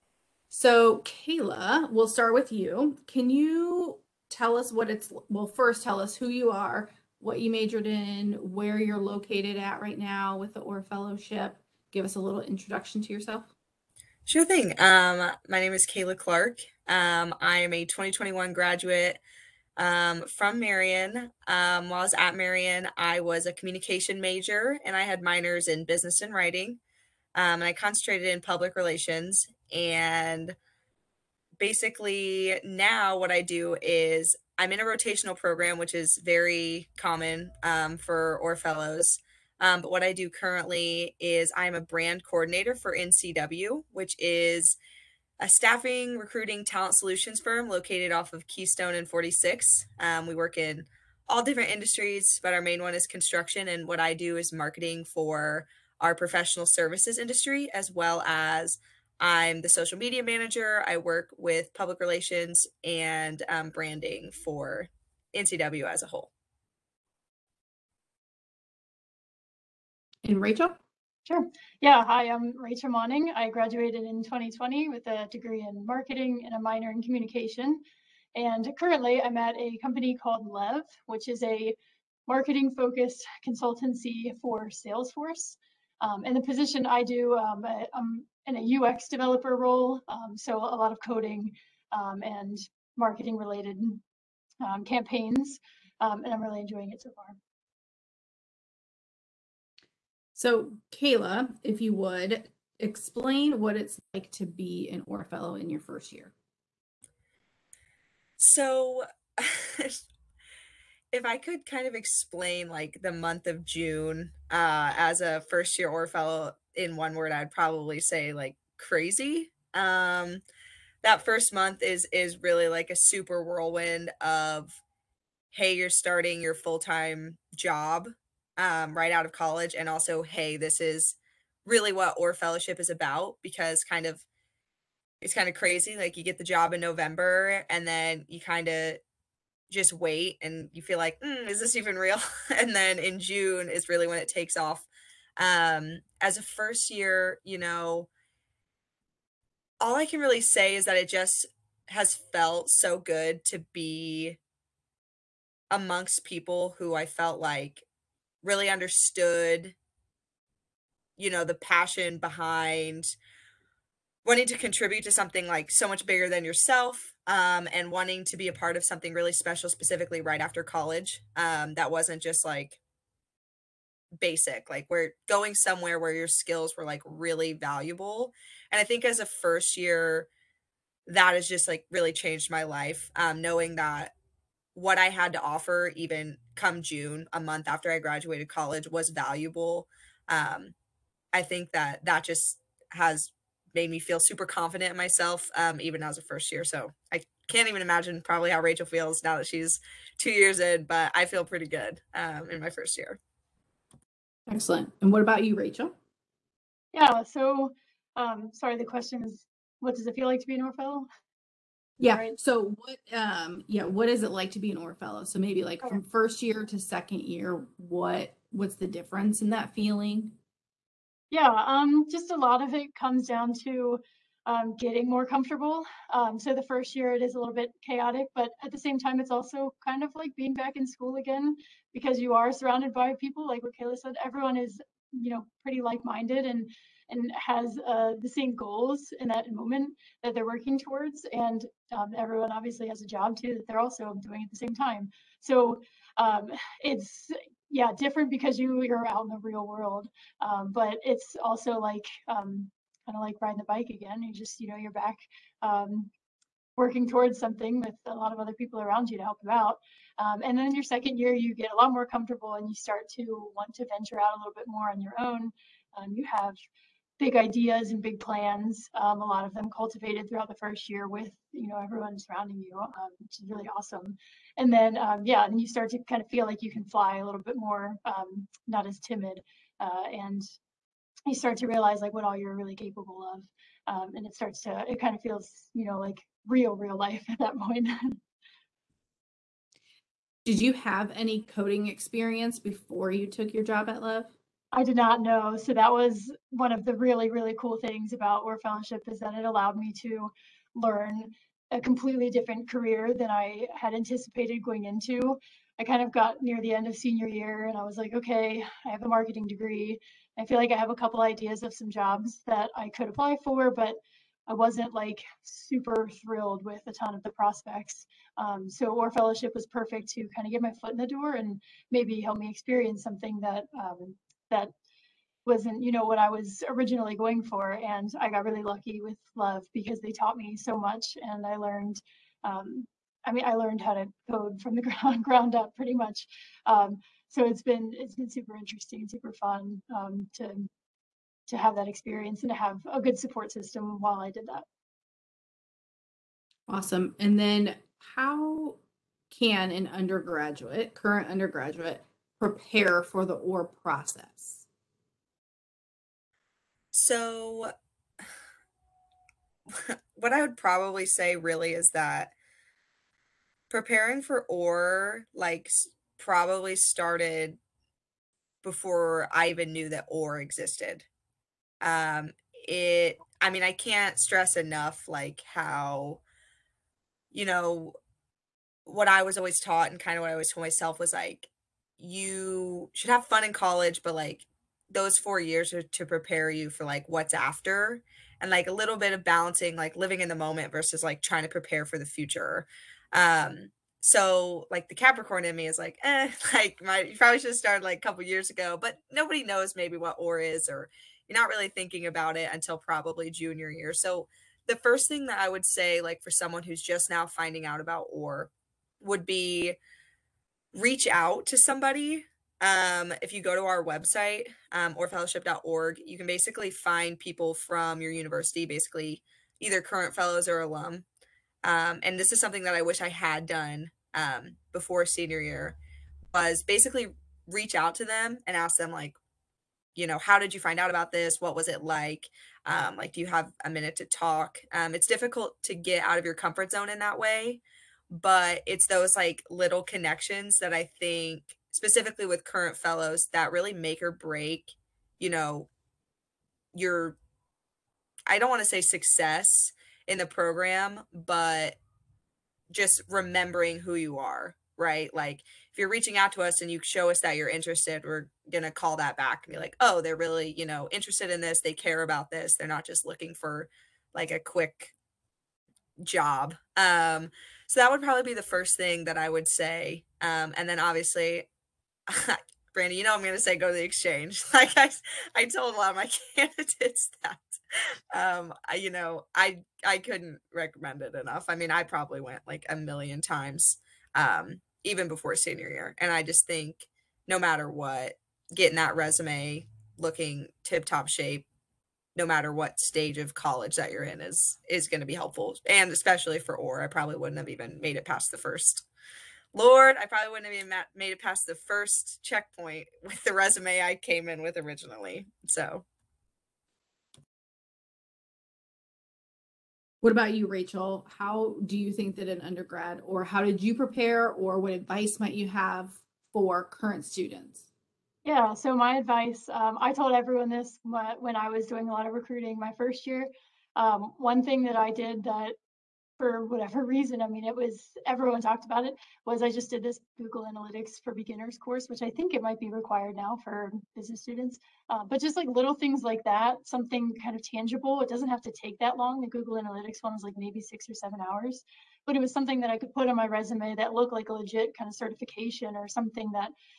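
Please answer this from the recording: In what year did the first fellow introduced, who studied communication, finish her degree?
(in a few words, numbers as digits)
2021.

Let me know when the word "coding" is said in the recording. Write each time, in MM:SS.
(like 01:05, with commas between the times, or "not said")
01:31, 04:51.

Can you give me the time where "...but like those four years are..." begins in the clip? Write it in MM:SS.
06:24.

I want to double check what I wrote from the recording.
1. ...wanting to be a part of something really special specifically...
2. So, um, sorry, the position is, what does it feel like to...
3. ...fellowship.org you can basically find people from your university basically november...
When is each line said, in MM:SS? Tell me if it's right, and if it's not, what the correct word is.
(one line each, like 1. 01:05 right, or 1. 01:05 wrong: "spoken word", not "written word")
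1. 02:47 right
2. 03:27 wrong: "question", not "position"
3. 06:55 wrong: "either", not "november".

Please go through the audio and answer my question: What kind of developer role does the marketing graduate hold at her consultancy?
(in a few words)
UX developer.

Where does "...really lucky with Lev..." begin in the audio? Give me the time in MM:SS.
05:28.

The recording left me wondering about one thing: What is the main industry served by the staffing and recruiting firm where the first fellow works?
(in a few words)
Construction.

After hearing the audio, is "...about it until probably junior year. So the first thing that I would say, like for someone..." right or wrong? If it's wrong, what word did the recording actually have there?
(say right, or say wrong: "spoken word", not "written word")
right.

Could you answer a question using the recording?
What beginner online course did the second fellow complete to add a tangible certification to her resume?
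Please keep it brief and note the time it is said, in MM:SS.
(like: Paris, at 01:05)
Google Analytics for Beginners, at 08:50.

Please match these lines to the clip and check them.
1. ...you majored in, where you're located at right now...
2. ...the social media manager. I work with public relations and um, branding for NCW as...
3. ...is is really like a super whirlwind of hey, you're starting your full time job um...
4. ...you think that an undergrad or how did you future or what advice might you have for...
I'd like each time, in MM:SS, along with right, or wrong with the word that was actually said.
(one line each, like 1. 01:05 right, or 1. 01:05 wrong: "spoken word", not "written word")
1. 00:07 right
2. 00:59 right
3. 02:01 right
4. 08:31 wrong: "prepare", not "future".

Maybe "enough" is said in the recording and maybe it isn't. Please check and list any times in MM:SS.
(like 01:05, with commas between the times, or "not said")
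06:14, 08:01.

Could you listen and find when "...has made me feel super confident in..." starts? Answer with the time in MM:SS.
03:12.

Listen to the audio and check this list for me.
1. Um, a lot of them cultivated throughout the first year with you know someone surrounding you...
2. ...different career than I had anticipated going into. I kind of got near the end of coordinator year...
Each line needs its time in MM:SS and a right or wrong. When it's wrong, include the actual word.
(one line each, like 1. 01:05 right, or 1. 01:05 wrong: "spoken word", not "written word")
1. 04:28 wrong: "everyone", not "someone"
2. 05:02 wrong: "senior", not "coordinator".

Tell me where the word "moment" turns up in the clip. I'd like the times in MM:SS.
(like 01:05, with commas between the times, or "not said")
03:59, 06:30.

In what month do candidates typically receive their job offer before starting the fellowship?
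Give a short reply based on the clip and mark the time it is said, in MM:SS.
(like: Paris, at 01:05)
November, at 02:16.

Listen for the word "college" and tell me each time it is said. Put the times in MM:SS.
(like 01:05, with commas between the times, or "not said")
02:09, 02:50, 03:08, 06:23, 08:13.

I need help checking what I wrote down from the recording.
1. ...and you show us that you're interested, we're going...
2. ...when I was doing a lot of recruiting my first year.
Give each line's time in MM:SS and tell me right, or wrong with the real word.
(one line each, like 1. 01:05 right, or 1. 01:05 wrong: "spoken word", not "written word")
1. 07:36 right
2. 08:40 right.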